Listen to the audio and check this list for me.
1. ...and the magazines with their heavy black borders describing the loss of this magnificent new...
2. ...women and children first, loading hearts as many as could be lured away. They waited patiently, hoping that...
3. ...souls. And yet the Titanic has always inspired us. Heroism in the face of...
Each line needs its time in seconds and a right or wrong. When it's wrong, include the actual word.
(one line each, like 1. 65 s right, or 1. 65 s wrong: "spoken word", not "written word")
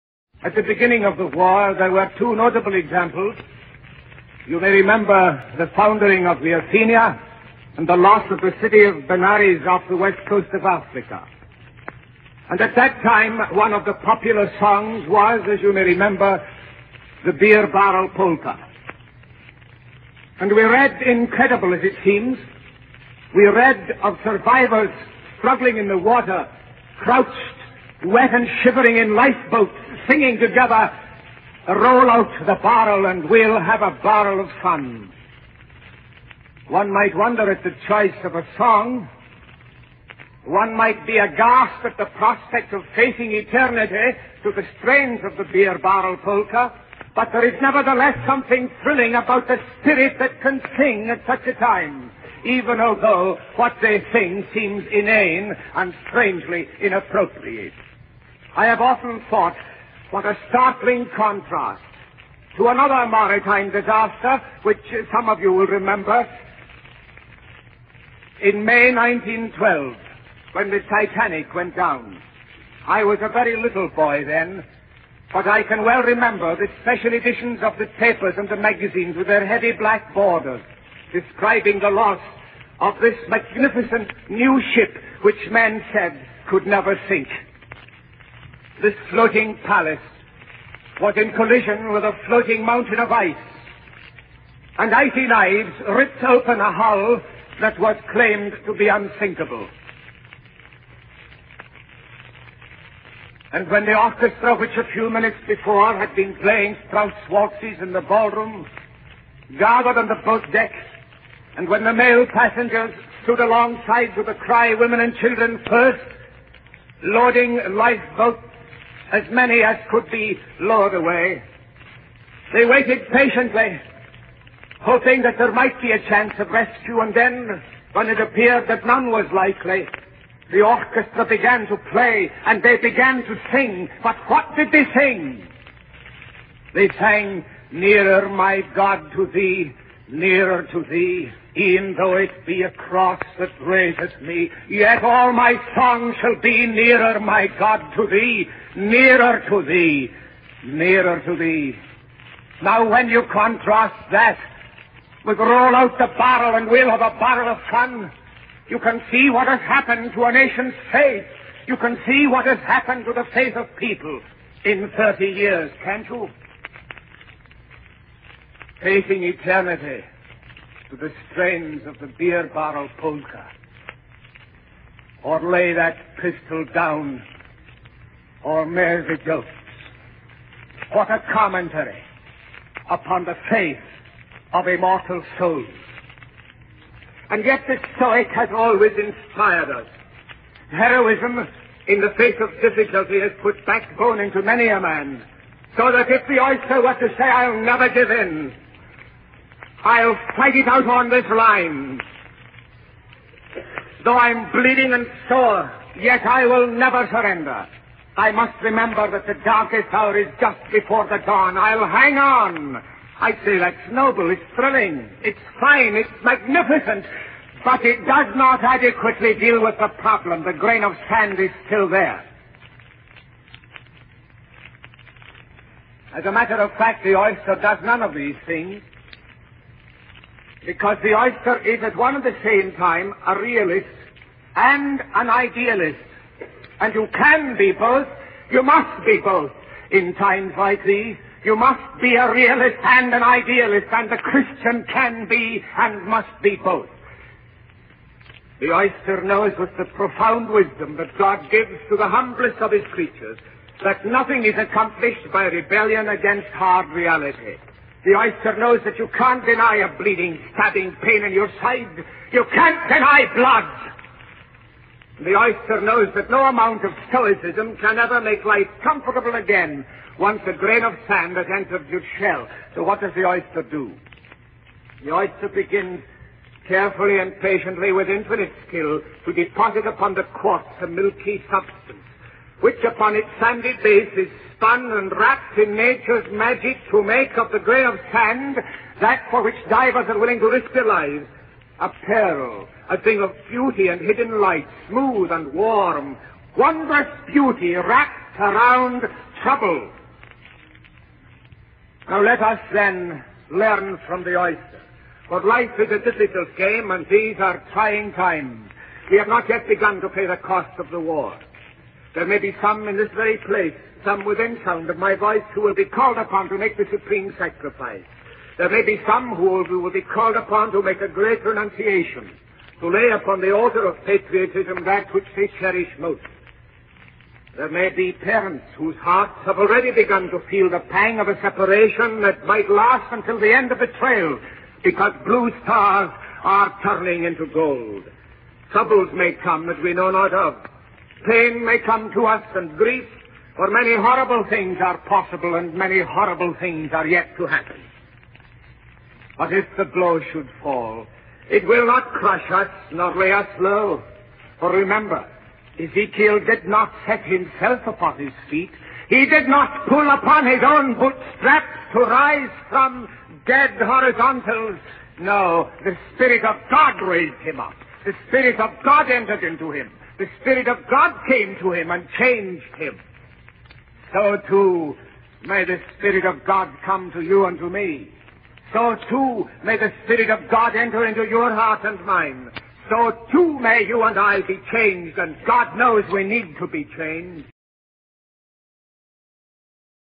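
1. 78 s right
2. 114 s wrong: "lifeboats", not "hearts"
3. 185 s wrong: "Stoic", not "Titanic".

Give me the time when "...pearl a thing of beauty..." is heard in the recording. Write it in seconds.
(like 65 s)
292 s.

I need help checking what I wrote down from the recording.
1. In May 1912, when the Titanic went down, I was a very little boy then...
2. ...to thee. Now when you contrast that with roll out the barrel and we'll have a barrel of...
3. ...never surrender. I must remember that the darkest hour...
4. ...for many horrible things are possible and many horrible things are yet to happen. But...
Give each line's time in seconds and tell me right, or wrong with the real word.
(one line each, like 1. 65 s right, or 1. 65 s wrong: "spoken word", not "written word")
1. 68 s right
2. 151 s right
3. 206 s right
4. 343 s right.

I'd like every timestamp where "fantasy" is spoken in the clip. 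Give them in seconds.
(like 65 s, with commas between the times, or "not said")
not said.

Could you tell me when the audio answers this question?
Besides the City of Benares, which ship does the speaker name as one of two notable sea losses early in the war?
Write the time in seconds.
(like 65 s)
6 s.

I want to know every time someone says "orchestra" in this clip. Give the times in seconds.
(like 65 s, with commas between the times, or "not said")
103 s, 130 s.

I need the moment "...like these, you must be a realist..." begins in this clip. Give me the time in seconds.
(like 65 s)
240 s.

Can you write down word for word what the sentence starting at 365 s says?
No, the Spirit of God raised him up.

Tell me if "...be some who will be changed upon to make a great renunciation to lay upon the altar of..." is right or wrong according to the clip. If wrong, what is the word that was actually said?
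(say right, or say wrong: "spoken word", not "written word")
wrong: "called", not "changed".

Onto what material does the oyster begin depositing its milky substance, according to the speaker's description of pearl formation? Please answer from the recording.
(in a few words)
quartz.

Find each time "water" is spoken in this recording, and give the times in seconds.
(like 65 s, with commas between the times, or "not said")
25 s.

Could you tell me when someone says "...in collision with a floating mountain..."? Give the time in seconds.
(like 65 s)
91 s.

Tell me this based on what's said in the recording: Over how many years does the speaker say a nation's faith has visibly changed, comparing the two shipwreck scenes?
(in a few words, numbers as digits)
30 years.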